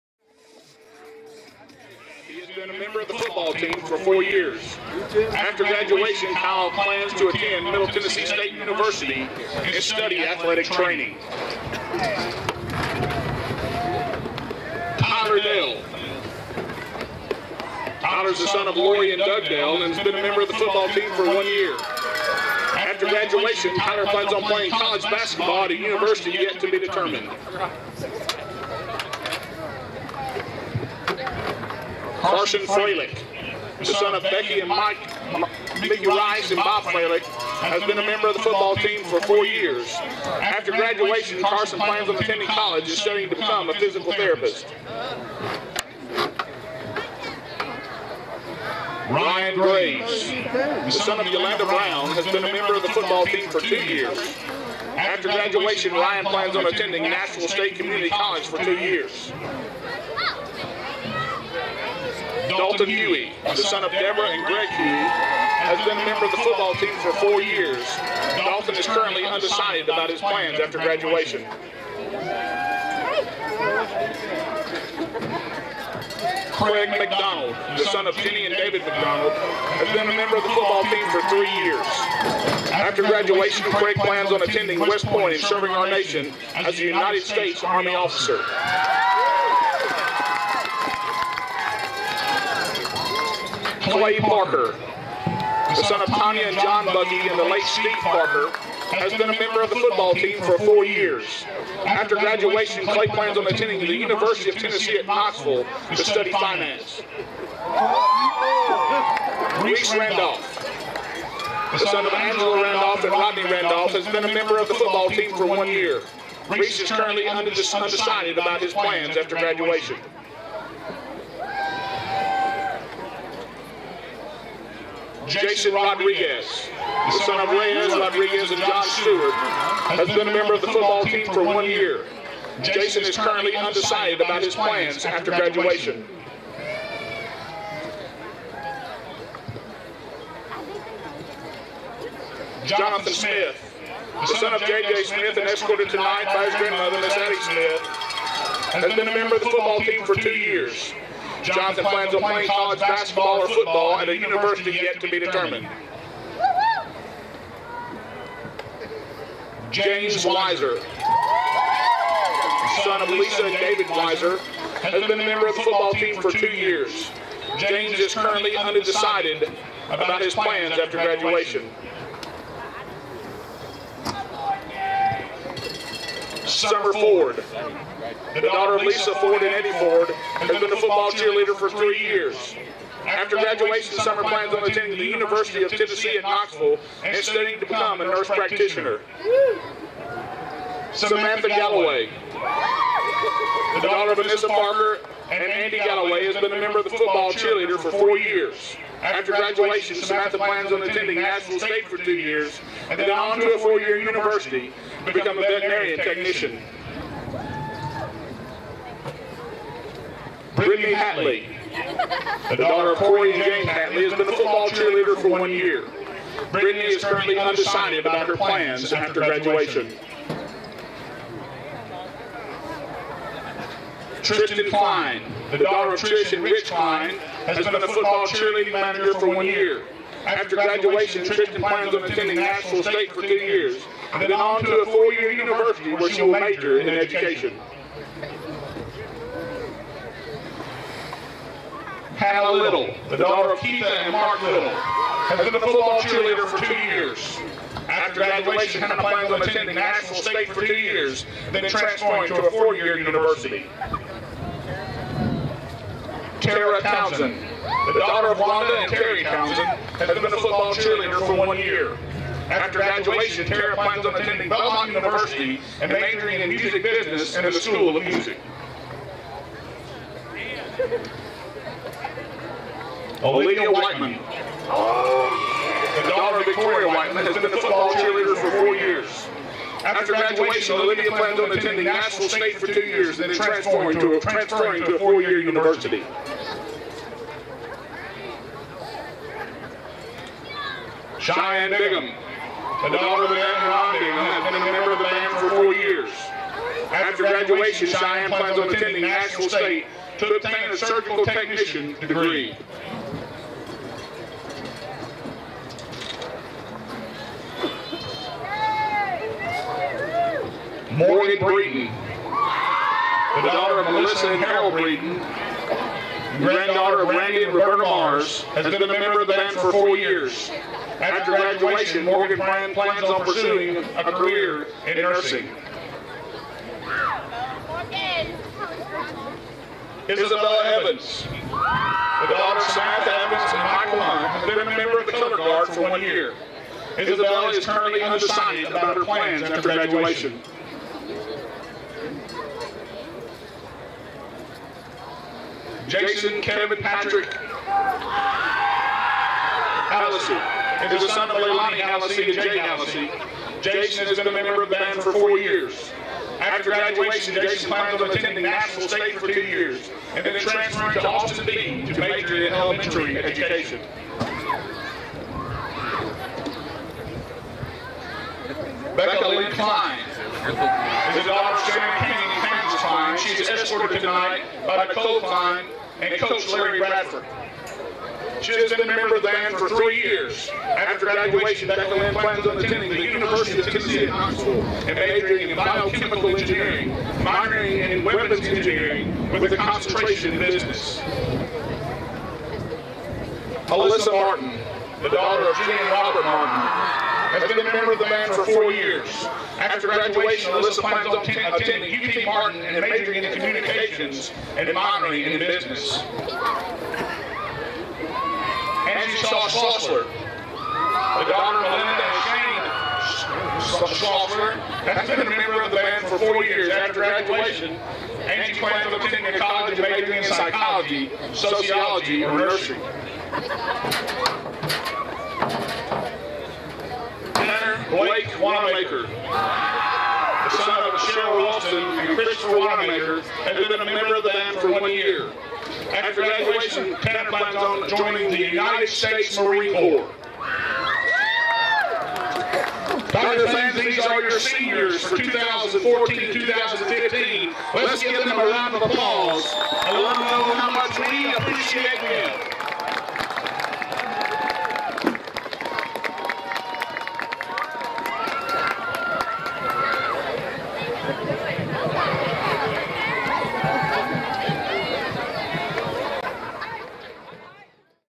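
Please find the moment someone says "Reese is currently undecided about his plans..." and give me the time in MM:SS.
01:56.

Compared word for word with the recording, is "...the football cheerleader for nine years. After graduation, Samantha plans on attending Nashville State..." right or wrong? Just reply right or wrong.
wrong.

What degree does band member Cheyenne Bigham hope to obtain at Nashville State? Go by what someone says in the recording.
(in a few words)
surgical technician.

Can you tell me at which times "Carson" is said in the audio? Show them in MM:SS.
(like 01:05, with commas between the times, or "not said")
00:32, 00:41.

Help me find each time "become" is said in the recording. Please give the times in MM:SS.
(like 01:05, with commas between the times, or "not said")
00:43, 03:07, 03:25.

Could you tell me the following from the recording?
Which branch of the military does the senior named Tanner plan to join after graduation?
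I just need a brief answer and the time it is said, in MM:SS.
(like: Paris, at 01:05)
United States Marine Corps, at 07:18.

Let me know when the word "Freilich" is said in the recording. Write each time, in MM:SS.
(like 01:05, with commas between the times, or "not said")
00:32, 00:36.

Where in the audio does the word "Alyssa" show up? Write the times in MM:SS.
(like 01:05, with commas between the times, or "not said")
06:40.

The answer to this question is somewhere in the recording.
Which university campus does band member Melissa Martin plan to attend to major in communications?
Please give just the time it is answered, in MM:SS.
06:41.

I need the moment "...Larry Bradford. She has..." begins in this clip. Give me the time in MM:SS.
06:16.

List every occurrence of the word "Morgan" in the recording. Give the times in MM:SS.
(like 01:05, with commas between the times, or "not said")
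05:10, 05:22.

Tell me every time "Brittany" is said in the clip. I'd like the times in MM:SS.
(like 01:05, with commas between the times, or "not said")
03:30, 03:36.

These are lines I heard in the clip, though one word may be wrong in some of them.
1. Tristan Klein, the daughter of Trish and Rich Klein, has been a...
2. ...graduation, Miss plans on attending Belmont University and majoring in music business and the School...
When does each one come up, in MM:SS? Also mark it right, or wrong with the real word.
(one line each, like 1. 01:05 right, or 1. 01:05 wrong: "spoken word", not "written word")
1. 03:44 right
2. 04:22 wrong: "Tara", not "Miss".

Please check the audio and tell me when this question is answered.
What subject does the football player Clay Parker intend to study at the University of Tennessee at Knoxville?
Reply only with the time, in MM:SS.
01:46.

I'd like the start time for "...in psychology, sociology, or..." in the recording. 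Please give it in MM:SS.
07:00.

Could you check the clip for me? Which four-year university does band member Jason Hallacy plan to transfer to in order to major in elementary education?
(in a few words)
Austin Peay.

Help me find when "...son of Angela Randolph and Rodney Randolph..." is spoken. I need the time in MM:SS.
01:51.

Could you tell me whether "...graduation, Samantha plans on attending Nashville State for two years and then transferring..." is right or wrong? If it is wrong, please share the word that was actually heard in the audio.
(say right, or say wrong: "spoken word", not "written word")
wrong: "Olivia", not "Samantha".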